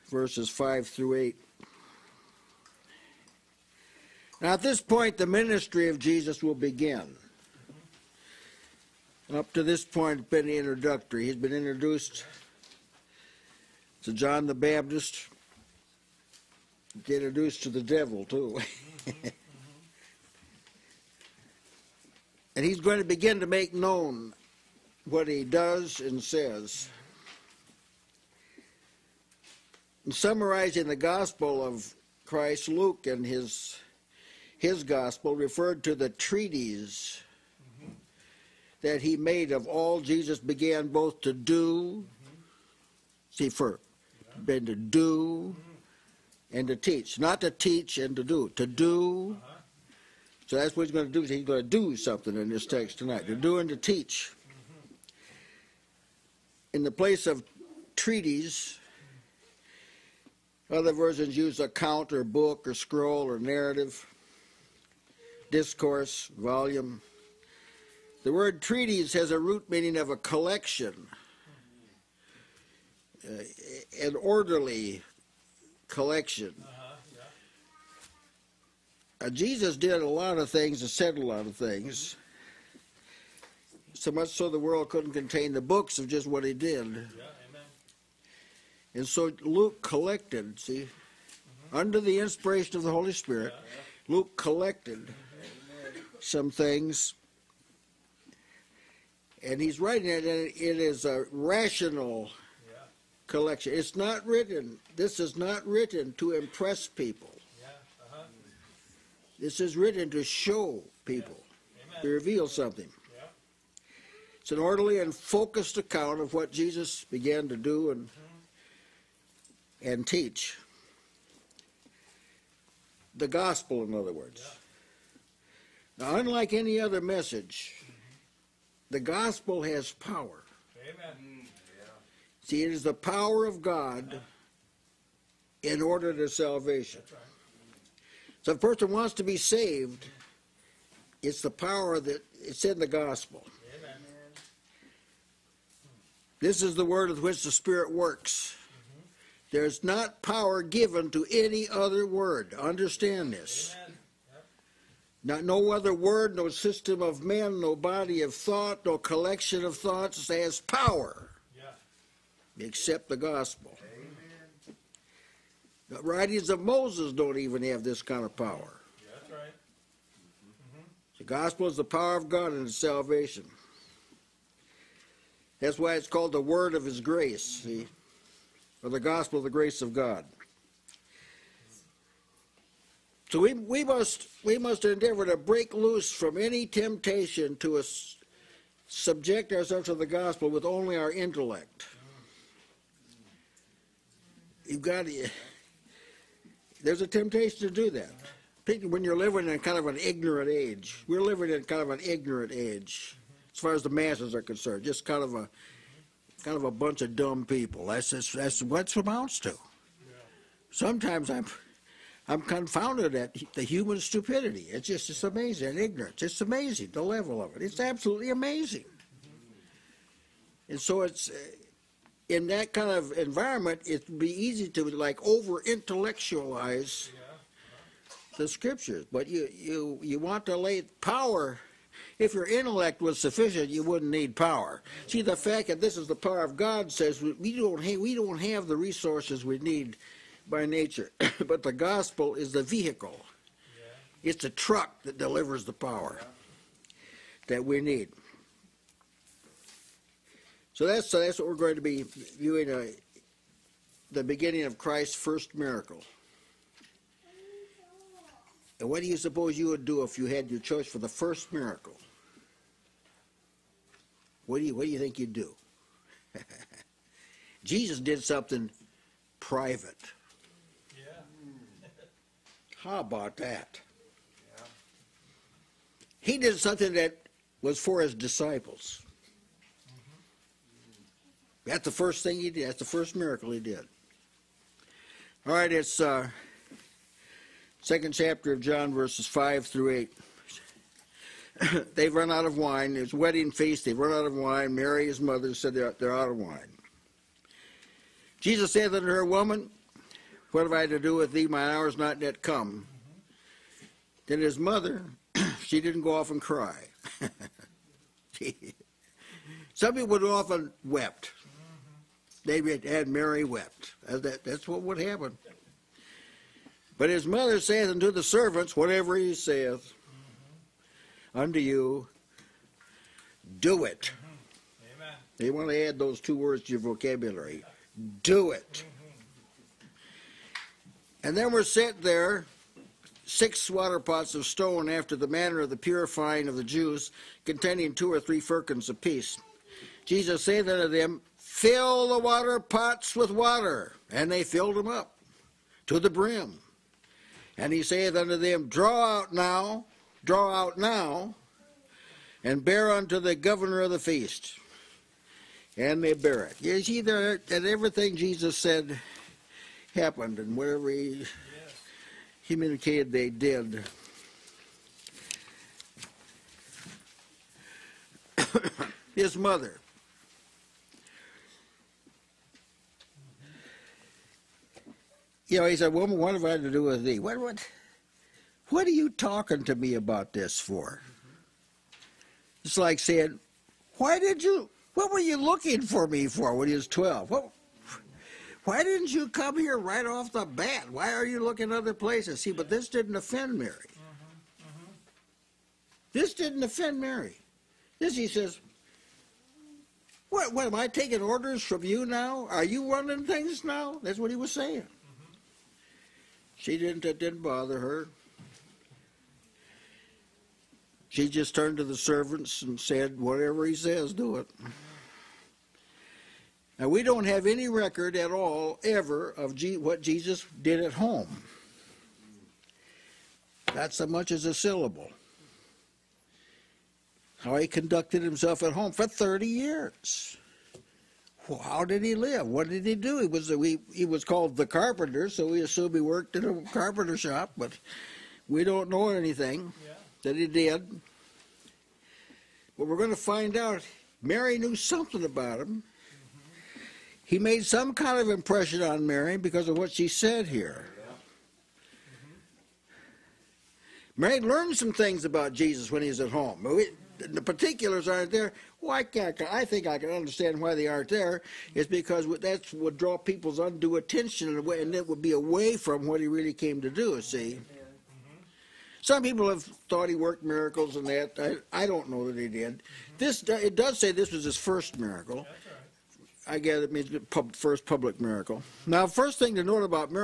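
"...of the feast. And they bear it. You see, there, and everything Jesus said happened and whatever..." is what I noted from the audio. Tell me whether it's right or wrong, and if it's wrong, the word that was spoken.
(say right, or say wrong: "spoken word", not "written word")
right.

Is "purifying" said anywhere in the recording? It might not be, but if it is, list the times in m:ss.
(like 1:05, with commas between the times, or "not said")
5:35.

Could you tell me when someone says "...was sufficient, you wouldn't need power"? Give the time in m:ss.
3:53.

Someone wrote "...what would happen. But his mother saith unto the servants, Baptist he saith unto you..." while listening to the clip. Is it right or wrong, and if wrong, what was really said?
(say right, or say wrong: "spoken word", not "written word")
wrong: "Whatever", not "Baptist".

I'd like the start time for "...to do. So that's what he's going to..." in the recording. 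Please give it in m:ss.
0:48.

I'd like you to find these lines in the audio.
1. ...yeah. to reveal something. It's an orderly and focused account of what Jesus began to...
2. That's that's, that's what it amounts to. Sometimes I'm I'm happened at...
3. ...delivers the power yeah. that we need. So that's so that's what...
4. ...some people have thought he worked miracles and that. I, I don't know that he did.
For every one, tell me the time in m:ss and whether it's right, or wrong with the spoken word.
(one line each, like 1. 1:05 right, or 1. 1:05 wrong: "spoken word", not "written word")
1. 1:51 right
2. 3:27 wrong: "confounded", not "happened"
3. 4:05 right
4. 7:49 right.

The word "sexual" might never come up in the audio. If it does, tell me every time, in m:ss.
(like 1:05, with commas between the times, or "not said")
not said.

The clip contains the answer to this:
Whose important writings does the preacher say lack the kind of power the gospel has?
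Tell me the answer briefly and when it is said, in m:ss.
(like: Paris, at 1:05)
Moses, at 2:46.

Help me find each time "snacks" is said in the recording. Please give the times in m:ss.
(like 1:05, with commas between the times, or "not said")
not said.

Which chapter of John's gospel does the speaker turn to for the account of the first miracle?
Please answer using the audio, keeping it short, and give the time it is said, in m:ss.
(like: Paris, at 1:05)
second chapter, at 4:47.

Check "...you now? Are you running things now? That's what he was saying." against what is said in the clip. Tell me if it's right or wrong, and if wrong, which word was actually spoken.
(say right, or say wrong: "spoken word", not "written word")
right.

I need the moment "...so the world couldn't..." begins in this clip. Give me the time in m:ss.
1:24.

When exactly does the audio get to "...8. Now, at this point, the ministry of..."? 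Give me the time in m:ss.
0:01.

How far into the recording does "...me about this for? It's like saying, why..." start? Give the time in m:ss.
6:19.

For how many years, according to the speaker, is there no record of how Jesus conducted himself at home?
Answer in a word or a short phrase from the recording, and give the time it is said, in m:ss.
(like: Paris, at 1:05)
30, at 7:09.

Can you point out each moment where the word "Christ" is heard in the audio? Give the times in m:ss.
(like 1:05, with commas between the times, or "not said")
0:32, 4:14.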